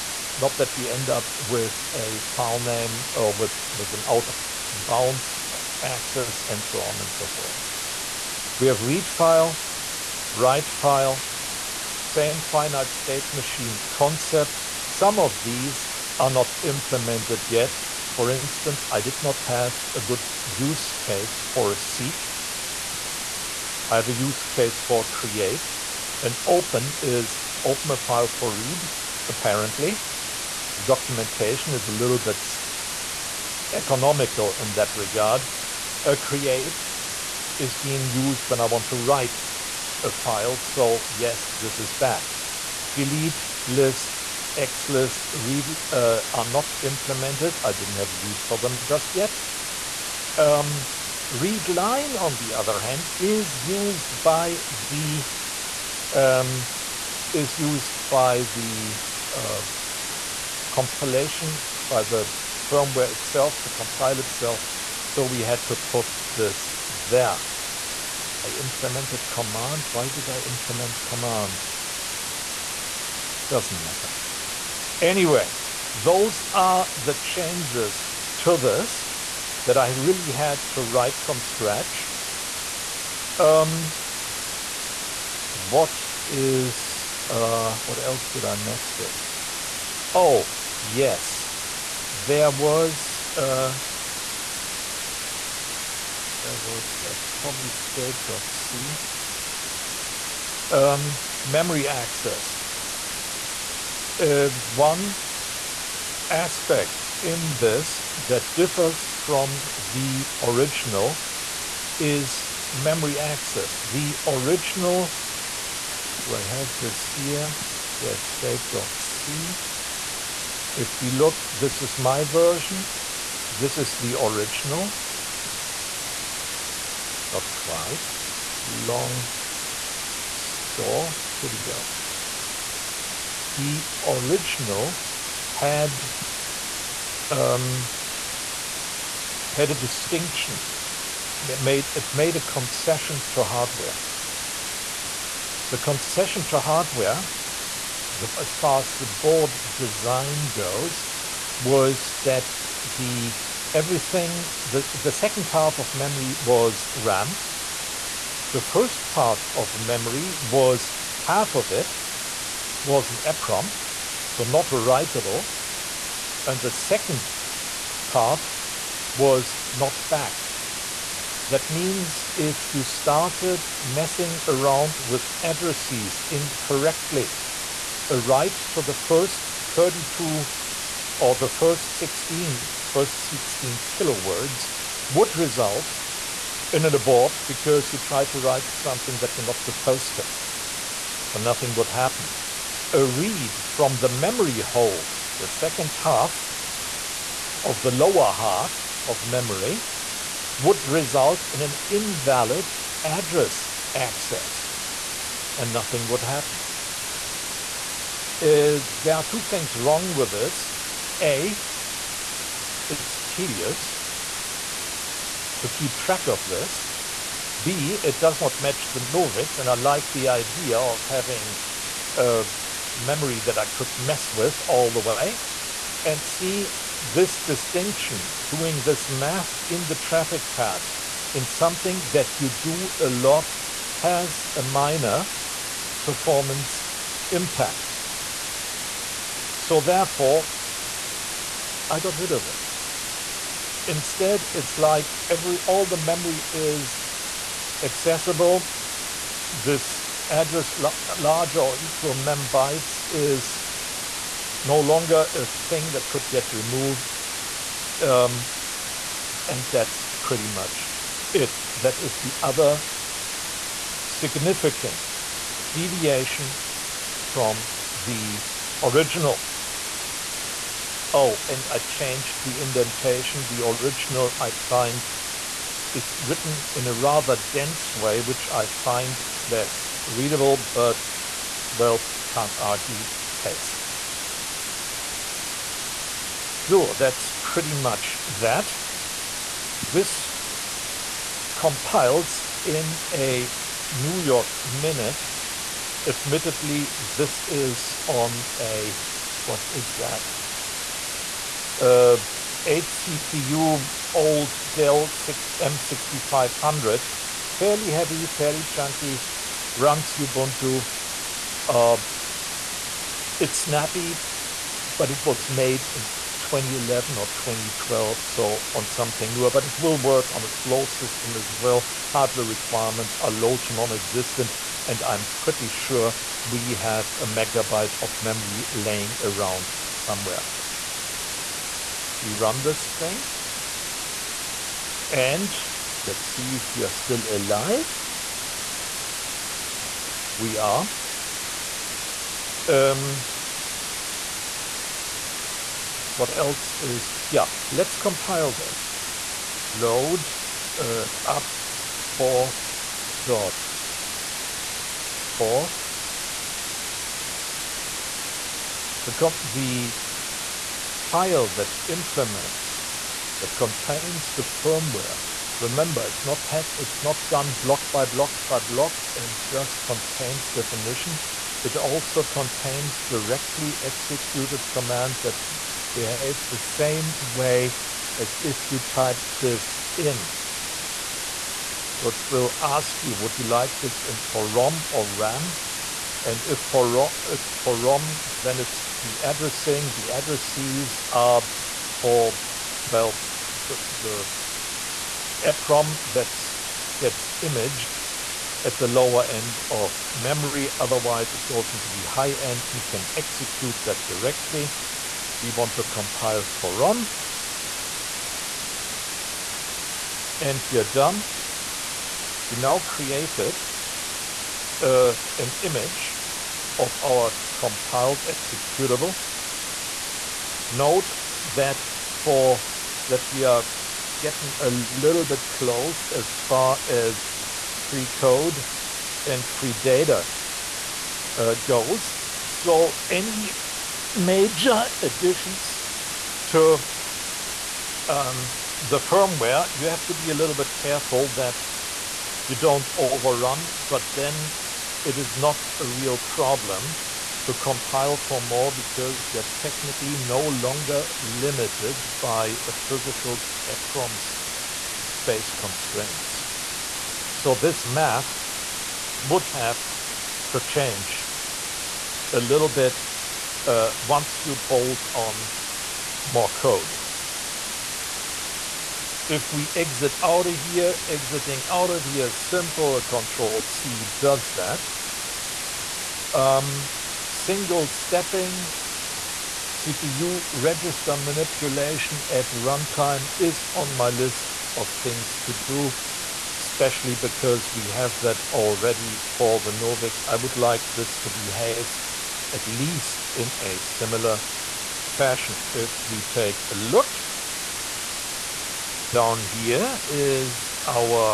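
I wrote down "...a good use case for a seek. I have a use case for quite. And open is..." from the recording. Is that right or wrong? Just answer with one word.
wrong.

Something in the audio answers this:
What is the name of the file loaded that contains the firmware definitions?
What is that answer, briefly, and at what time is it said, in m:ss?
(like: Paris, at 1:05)
up forth dot forth, at 5:51.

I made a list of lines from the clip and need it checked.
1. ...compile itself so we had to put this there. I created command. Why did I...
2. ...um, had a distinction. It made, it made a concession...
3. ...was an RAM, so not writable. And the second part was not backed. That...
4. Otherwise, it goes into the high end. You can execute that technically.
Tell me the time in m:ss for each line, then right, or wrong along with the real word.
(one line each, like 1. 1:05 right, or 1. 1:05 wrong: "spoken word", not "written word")
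1. 1:03 wrong: "implemented", not "created"
2. 2:17 right
3. 2:42 wrong: "EPROM", not "RAM"
4. 6:40 wrong: "directly", not "technically".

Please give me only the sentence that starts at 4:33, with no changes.
The original I find is written in a rather dense way, which I find less readable, but well, can't argue taste.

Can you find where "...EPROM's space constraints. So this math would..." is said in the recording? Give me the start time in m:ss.
7:33.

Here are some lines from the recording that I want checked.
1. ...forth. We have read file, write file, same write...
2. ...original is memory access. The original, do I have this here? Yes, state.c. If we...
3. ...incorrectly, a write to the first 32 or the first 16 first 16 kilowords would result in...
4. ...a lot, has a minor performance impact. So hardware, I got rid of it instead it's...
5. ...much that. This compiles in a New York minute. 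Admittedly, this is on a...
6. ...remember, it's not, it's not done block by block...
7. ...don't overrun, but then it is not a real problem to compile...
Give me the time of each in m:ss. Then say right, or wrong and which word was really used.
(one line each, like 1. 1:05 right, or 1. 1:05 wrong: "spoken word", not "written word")
1. 0:07 wrong: "finite", not "write"
2. 1:50 right
3. 2:56 right
4. 3:52 wrong: "therefore", not "hardware"
5. 4:47 right
6. 6:05 right
7. 7:22 right.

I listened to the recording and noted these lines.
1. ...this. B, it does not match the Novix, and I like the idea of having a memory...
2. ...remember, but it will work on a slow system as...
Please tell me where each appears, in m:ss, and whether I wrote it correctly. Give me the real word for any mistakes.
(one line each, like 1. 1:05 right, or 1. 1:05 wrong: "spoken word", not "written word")
1. 3:36 right
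2. 5:19 wrong: "newer", not "remember".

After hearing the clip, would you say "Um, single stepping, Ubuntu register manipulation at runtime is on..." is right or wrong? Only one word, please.
wrong.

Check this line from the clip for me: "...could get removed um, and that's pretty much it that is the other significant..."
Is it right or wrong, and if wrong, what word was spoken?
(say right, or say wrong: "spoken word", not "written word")
right.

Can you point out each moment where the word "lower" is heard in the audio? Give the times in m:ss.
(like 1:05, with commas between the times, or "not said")
3:17, 6:38.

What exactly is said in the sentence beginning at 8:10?
I would like this to behave at least in a similar fashion.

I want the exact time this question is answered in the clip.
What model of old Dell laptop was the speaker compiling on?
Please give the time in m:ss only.
5:05.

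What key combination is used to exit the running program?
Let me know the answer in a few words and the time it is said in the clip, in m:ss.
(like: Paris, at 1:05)
Control C, at 7:53.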